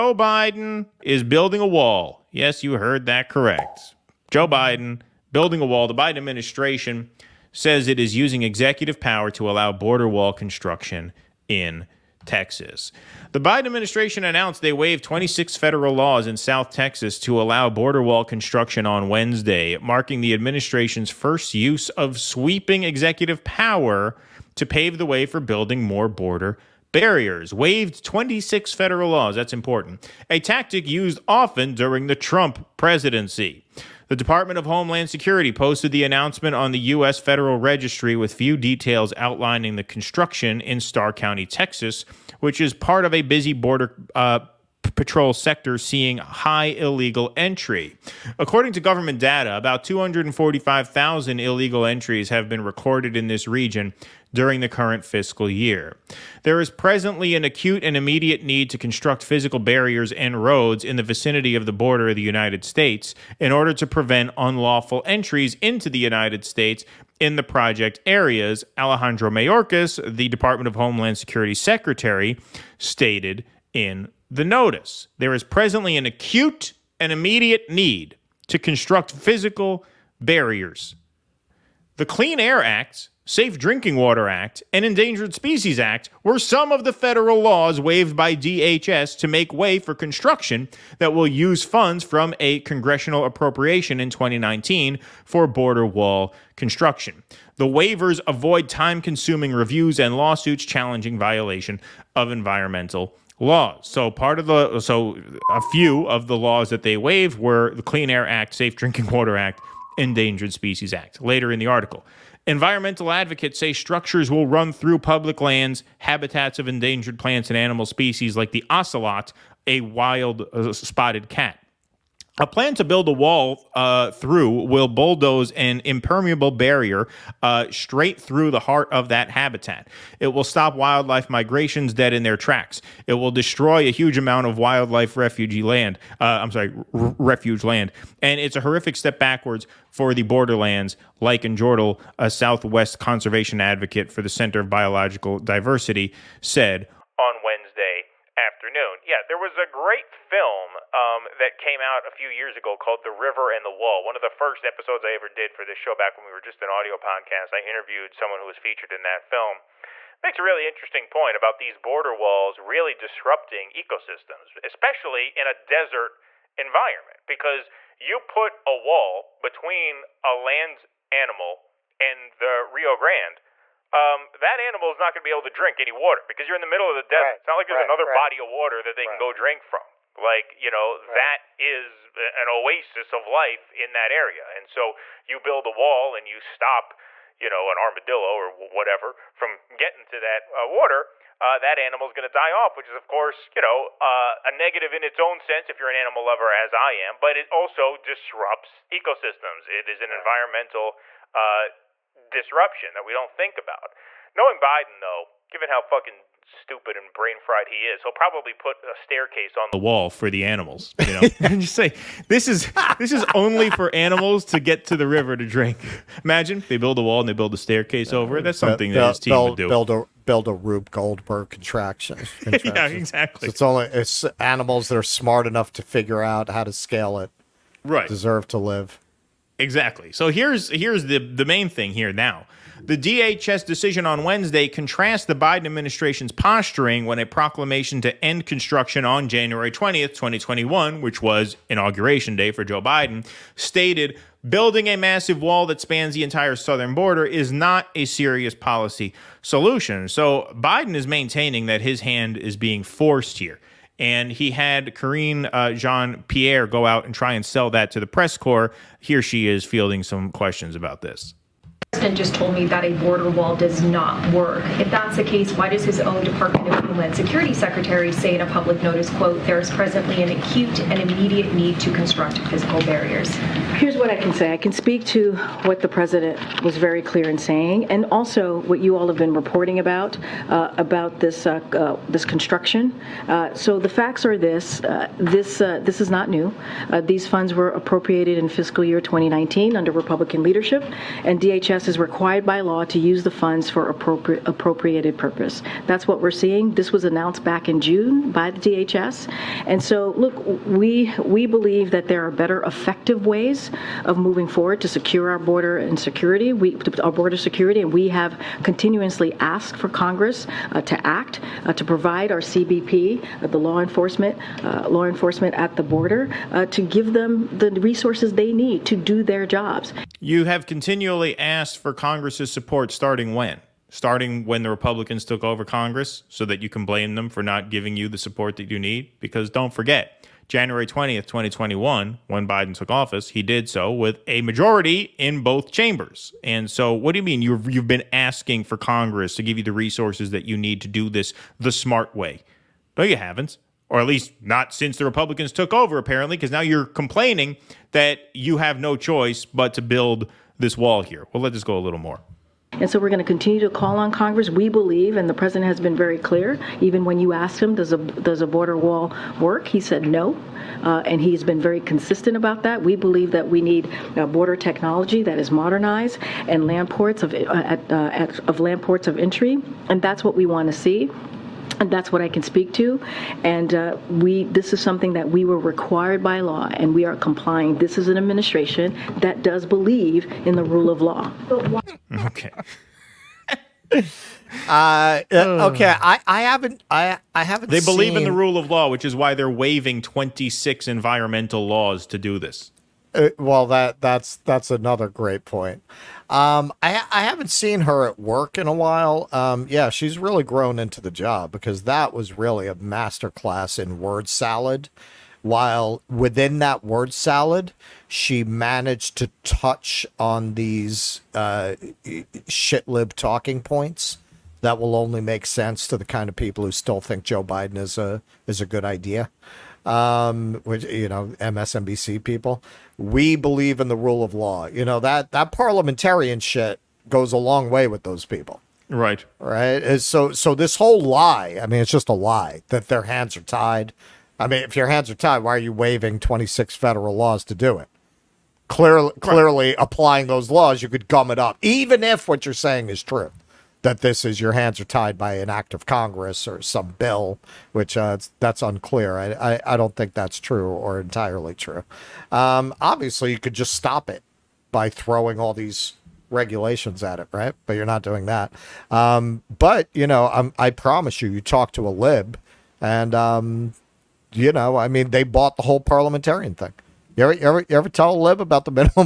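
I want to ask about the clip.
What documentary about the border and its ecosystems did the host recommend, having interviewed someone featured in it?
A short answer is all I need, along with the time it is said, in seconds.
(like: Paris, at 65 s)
The River and the Wall, at 153 s.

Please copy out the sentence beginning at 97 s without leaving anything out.
The waivers avoid time consuming reviews and lawsuits challenging violation of environmental laws.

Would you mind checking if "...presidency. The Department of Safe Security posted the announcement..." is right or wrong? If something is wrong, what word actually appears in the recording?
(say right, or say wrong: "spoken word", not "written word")
wrong: "Homeland", not "Safe".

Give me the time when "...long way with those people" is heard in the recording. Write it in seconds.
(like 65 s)
427 s.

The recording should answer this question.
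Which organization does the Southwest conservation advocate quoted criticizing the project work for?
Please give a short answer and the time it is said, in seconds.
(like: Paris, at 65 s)
Center of Biological Diversity, at 144 s.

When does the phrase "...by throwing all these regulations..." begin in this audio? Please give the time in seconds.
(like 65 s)
454 s.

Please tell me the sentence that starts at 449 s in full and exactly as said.
I, I, I, don't think that's true or entirely true.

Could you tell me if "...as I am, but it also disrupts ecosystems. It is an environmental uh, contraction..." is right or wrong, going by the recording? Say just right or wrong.
wrong.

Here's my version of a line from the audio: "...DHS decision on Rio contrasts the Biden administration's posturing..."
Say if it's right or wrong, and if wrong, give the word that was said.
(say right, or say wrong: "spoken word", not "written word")
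wrong: "Wednesday", not "Rio".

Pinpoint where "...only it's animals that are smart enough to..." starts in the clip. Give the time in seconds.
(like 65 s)
223 s.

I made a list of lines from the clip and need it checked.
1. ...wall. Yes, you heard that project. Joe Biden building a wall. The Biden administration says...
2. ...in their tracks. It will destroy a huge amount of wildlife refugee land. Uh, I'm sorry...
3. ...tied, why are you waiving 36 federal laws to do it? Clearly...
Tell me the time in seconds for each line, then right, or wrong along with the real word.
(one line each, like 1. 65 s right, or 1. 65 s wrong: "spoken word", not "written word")
1. 1 s wrong: "correct", not "project"
2. 132 s right
3. 435 s wrong: "26", not "36".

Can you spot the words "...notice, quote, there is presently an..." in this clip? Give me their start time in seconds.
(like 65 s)
268 s.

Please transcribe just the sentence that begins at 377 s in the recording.
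This is an administration that does believe in the rule of law.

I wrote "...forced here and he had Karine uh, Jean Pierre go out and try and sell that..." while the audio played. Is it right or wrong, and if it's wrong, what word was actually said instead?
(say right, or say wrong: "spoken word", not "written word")
right.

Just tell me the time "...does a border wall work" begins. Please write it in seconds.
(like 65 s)
357 s.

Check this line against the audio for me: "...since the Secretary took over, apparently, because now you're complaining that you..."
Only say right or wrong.
wrong.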